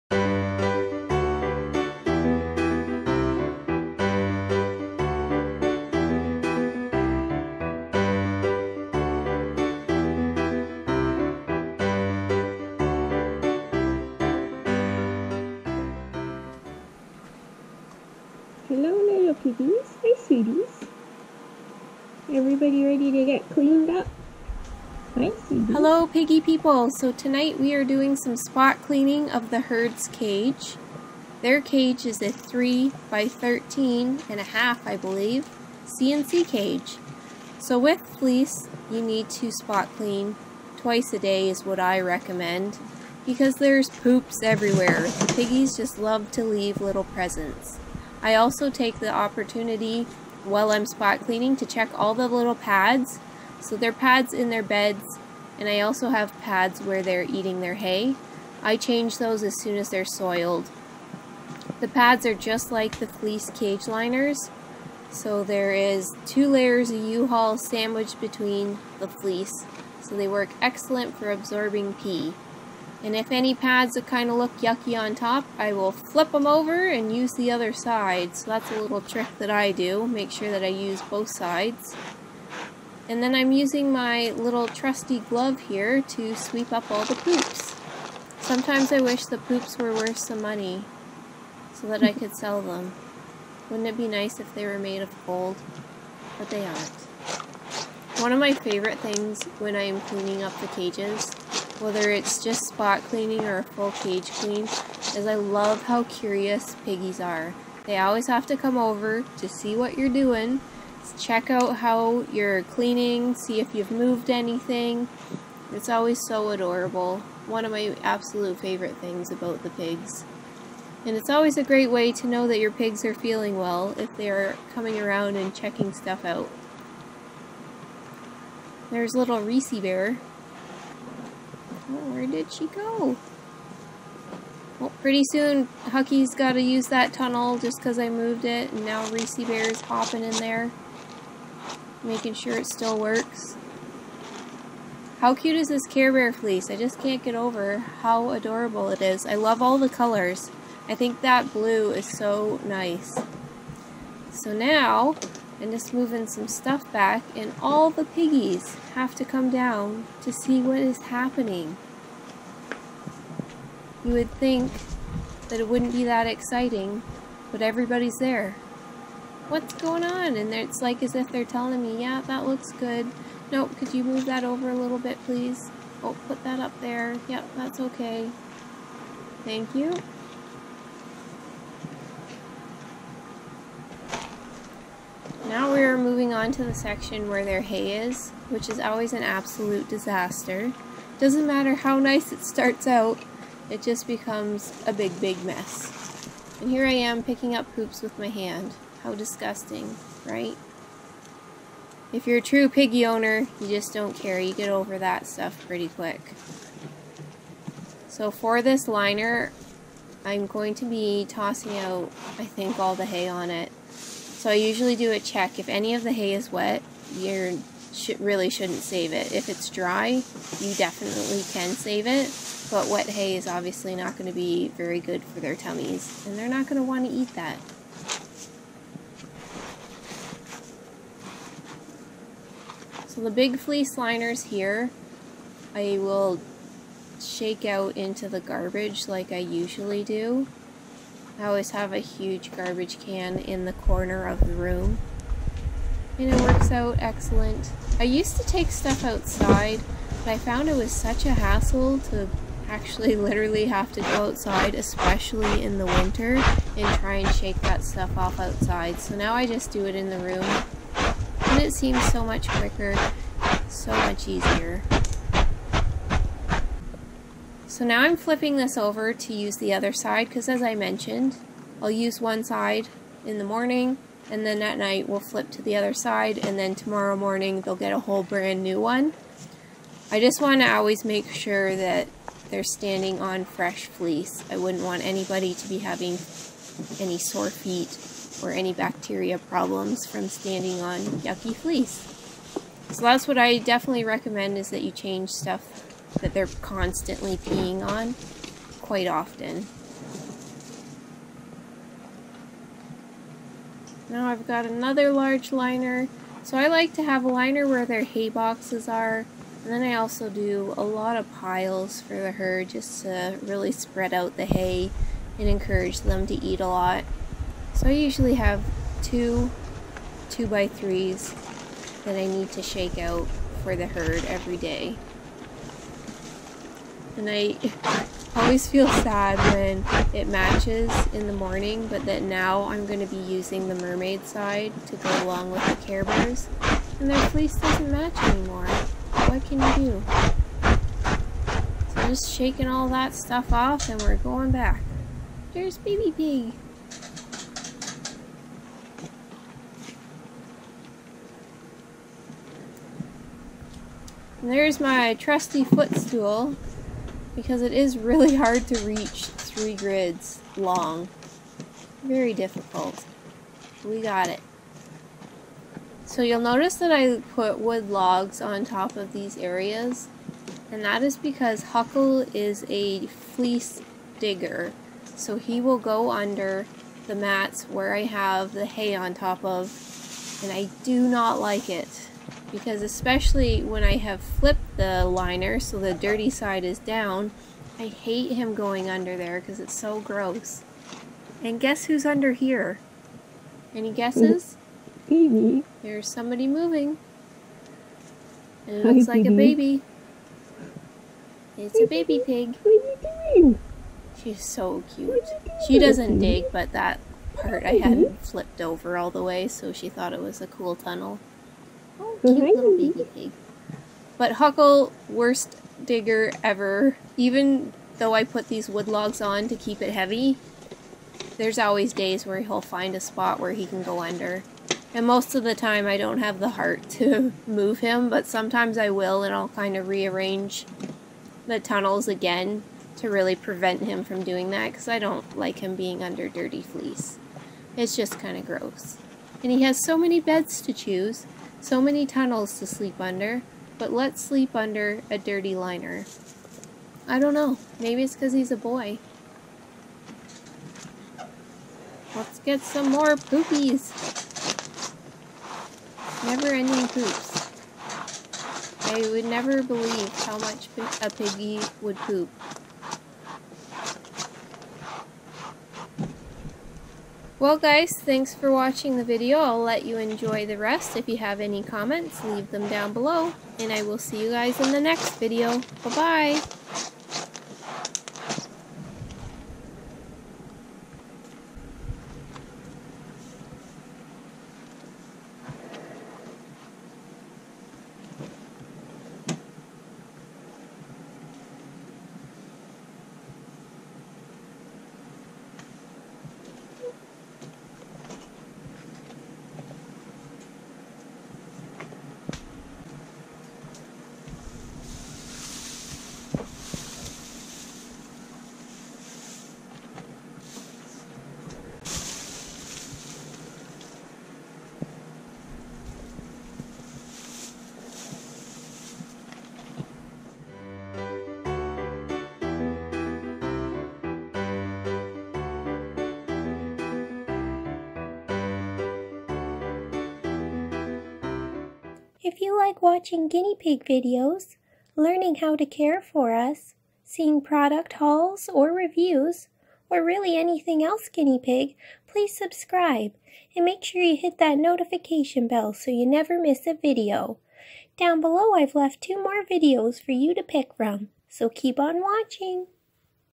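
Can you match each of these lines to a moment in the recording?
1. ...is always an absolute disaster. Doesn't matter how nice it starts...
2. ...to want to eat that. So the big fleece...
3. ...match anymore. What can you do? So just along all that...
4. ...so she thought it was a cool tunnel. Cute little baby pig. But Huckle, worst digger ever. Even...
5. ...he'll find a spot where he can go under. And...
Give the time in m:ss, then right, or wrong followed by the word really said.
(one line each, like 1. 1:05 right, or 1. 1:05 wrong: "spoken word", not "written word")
1. 3:08 right
2. 3:46 right
3. 5:37 wrong: "shaking", not "along"
4. 6:49 right
5. 7:02 right.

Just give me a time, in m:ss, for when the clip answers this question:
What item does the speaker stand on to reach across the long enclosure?
5:55.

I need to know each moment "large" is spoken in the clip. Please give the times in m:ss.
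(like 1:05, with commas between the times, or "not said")
5:05.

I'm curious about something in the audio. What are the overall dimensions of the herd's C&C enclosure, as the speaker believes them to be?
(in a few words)
3 by 13 and a half.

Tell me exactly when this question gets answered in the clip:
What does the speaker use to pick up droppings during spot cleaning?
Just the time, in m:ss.
1:25.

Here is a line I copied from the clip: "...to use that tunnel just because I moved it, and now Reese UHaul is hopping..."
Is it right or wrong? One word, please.
wrong.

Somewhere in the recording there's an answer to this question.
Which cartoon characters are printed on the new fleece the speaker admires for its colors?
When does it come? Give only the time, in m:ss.
2:25.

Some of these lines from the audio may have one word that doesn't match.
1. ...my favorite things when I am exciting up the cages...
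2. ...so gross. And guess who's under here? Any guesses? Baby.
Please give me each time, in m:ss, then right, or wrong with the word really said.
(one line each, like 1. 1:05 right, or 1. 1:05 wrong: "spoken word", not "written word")
1. 1:38 wrong: "cleaning", not "exciting"
2. 6:29 right.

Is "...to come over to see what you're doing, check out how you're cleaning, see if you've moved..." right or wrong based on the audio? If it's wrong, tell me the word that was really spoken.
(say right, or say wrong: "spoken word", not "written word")
right.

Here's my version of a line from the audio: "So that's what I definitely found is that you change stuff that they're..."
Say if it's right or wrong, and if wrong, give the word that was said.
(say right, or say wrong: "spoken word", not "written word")
wrong: "recommend", not "found".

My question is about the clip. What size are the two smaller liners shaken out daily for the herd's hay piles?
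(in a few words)
2 by 3.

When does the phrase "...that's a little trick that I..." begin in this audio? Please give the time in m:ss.
1:18.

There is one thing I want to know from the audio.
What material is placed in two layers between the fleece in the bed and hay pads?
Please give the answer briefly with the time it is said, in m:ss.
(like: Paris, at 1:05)
U-Haul, at 1:07.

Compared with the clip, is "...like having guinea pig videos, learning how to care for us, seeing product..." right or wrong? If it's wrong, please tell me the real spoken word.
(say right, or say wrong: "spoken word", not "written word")
wrong: "watching", not "having".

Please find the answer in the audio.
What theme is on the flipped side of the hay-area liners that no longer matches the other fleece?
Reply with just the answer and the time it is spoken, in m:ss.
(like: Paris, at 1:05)
mermaid, at 5:33.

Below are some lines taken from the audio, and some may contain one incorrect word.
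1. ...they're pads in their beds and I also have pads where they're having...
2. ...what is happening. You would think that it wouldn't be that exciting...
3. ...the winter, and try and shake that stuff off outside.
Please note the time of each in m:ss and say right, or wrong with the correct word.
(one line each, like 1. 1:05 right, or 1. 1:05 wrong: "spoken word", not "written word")
1. 0:53 wrong: "eating", not "having"
2. 2:40 right
3. 4:15 right.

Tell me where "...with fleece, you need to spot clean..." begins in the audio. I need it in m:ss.
0:37.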